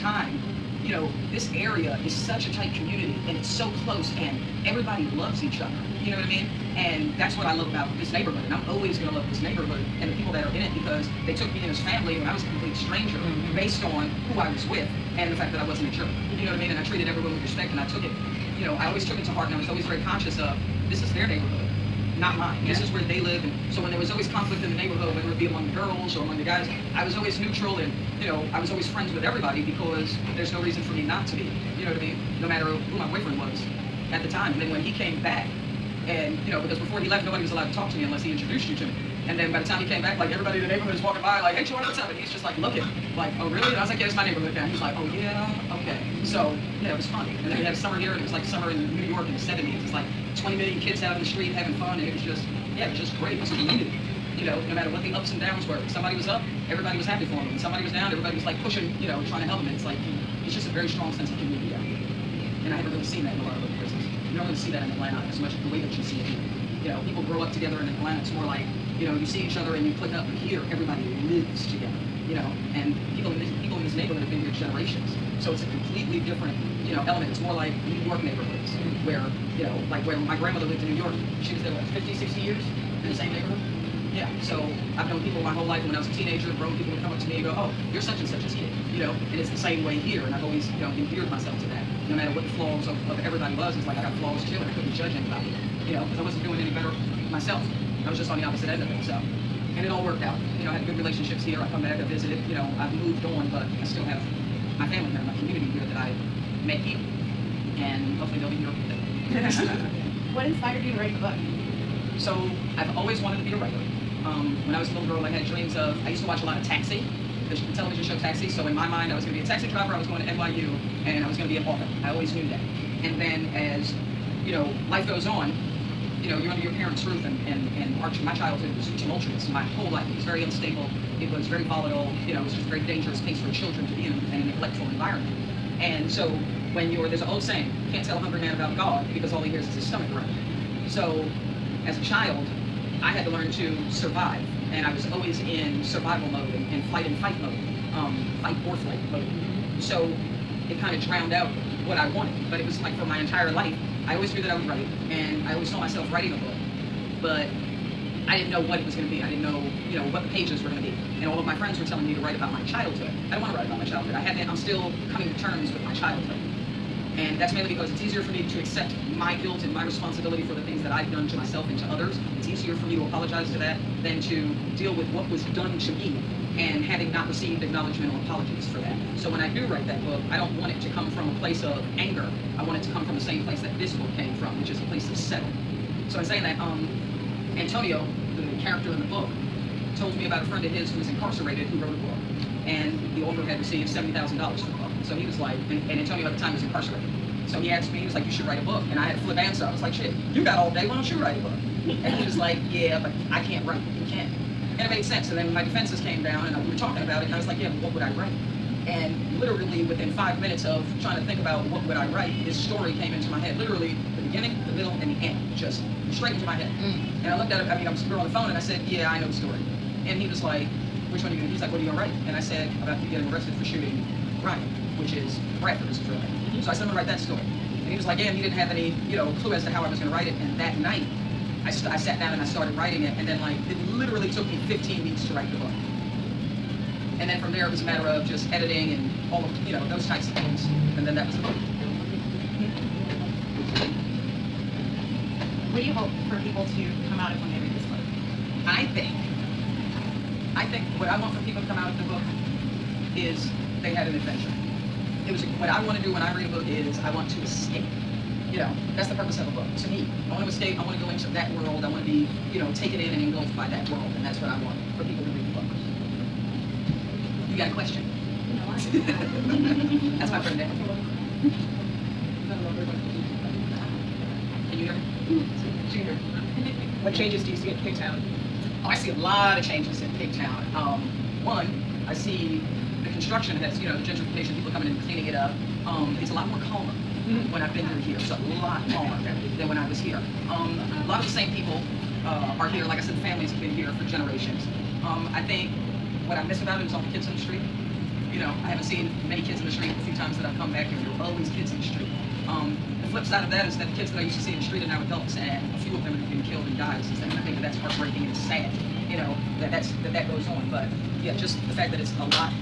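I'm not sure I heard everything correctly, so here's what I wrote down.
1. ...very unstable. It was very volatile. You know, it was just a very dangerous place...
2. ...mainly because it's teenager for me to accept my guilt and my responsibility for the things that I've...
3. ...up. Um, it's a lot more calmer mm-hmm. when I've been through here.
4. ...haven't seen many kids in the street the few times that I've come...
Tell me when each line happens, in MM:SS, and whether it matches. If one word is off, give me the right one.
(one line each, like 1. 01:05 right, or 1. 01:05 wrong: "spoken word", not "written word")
1. 02:10 right
2. 02:47 wrong: "easier", not "teenager"
3. 04:45 right
4. 04:58 right.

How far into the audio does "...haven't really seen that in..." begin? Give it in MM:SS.
01:02.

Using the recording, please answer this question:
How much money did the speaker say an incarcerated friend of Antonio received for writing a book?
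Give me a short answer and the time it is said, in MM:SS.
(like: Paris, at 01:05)
$70,000, at 03:13.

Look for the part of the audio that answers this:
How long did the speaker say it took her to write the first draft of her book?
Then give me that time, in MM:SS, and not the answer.
03:54.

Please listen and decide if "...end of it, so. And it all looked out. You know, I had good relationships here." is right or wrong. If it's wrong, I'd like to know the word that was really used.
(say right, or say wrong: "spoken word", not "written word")
wrong: "worked", not "looked".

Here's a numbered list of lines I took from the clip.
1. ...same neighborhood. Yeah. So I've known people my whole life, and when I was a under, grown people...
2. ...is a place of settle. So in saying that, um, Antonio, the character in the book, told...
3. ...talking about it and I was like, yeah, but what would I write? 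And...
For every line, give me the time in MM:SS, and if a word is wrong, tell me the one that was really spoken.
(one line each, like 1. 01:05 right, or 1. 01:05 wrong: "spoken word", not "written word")
1. 01:23 wrong: "teenager", not "under"
2. 03:04 right
3. 03:26 right.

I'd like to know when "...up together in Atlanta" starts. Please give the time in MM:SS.
01:07.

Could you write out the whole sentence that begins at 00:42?
And he's just like looking, like, oh really?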